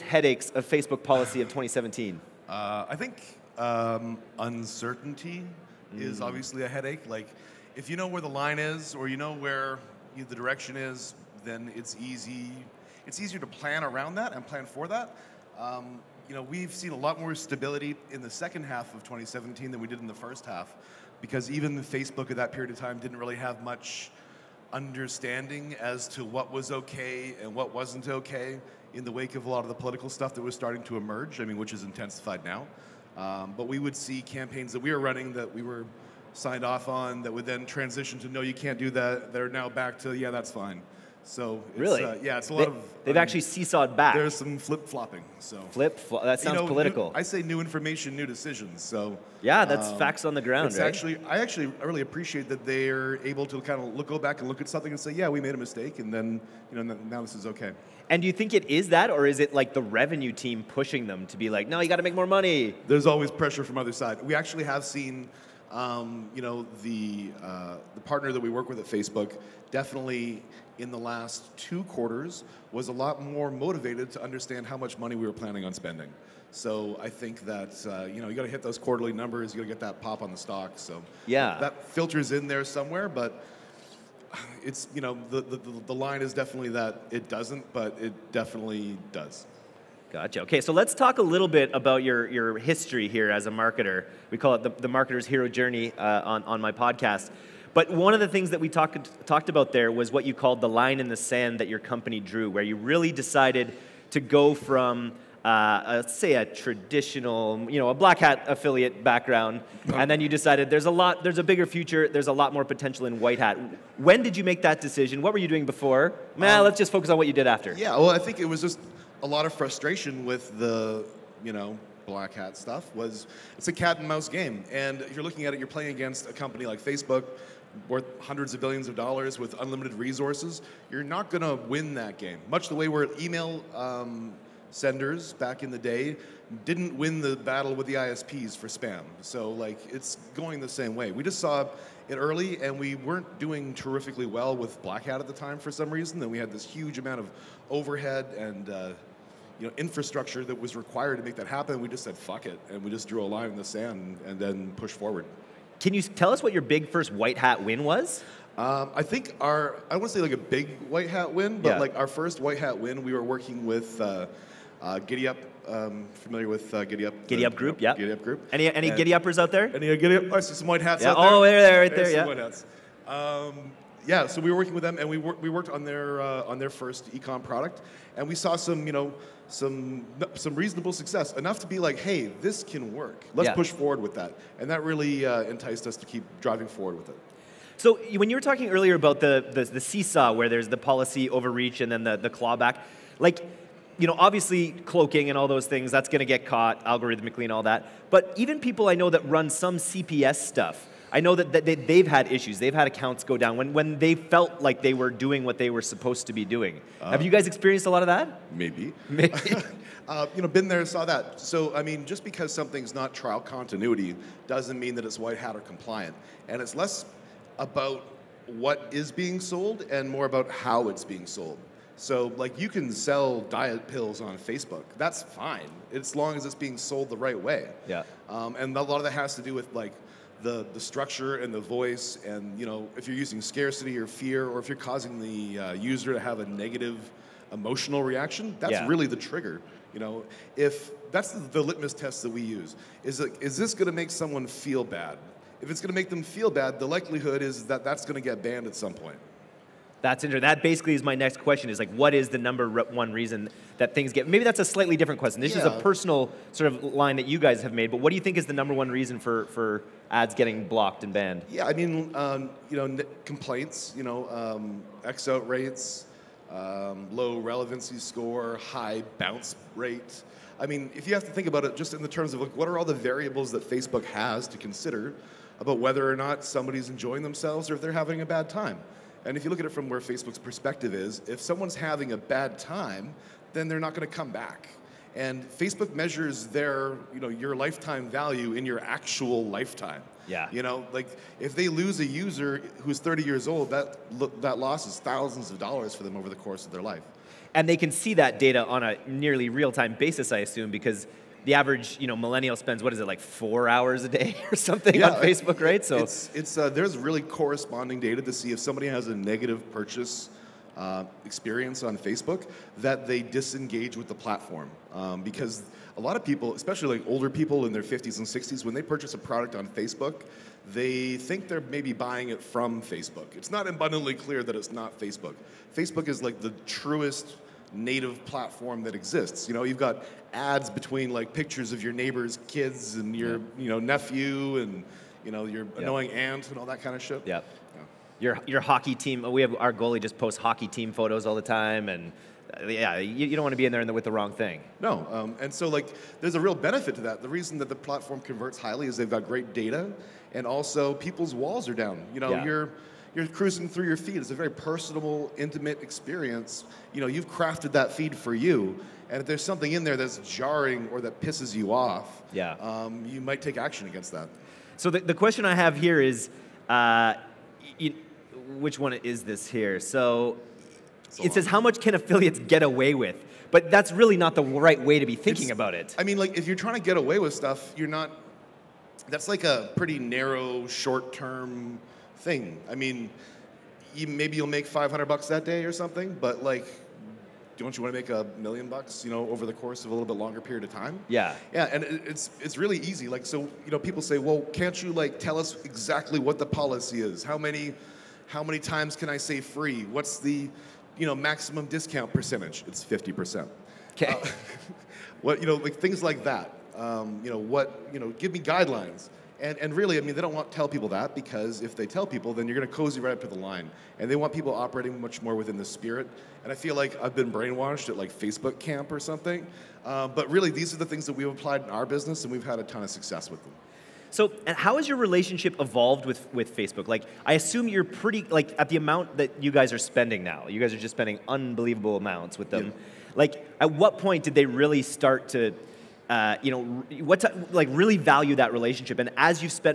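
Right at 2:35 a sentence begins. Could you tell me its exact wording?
Can you tell us what your big first white hat win was?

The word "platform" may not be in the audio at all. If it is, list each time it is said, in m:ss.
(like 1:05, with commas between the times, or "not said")
5:14, 5:28, 5:47.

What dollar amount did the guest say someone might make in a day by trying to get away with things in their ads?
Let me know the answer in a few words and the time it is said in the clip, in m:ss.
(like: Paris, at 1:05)
500, at 6:24.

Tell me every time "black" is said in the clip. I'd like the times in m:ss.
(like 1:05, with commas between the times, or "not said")
1:47, 2:02, 2:24.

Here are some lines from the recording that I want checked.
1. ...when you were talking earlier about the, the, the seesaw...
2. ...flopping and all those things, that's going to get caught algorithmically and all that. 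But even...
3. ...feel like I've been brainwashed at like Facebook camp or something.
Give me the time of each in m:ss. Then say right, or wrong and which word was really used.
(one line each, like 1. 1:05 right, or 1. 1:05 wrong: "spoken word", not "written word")
1. 3:08 right
2. 3:14 wrong: "cloaking", not "flopping"
3. 6:56 right.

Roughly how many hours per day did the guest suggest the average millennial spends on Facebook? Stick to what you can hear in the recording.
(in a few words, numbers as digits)
4.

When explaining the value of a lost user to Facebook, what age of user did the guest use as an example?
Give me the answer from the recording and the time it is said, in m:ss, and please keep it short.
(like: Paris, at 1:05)
30, at 4:52.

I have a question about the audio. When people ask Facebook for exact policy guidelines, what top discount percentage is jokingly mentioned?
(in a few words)
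50 percent.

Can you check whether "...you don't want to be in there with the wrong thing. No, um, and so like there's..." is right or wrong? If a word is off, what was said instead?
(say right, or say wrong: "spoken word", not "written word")
right.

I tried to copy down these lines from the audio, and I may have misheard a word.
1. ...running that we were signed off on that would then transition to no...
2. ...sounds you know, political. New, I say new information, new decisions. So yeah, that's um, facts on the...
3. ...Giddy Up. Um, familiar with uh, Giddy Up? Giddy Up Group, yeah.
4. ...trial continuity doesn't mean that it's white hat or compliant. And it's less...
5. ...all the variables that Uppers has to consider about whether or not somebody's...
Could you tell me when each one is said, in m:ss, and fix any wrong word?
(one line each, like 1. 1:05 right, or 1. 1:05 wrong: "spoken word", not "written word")
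1. 0:35 right
2. 0:46 right
3. 2:44 right
4. 3:33 right
5. 4:32 wrong: "Facebook", not "Uppers".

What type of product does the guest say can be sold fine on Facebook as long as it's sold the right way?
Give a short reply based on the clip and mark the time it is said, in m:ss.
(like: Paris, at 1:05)
Diet pills, at 3:43.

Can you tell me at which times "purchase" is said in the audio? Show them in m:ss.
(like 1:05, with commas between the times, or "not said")
5:09, 5:18.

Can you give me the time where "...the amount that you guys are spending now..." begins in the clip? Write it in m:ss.
7:08.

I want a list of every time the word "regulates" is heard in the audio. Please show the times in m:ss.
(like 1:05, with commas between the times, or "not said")
not said.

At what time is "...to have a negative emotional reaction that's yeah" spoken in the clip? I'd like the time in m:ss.
3:56.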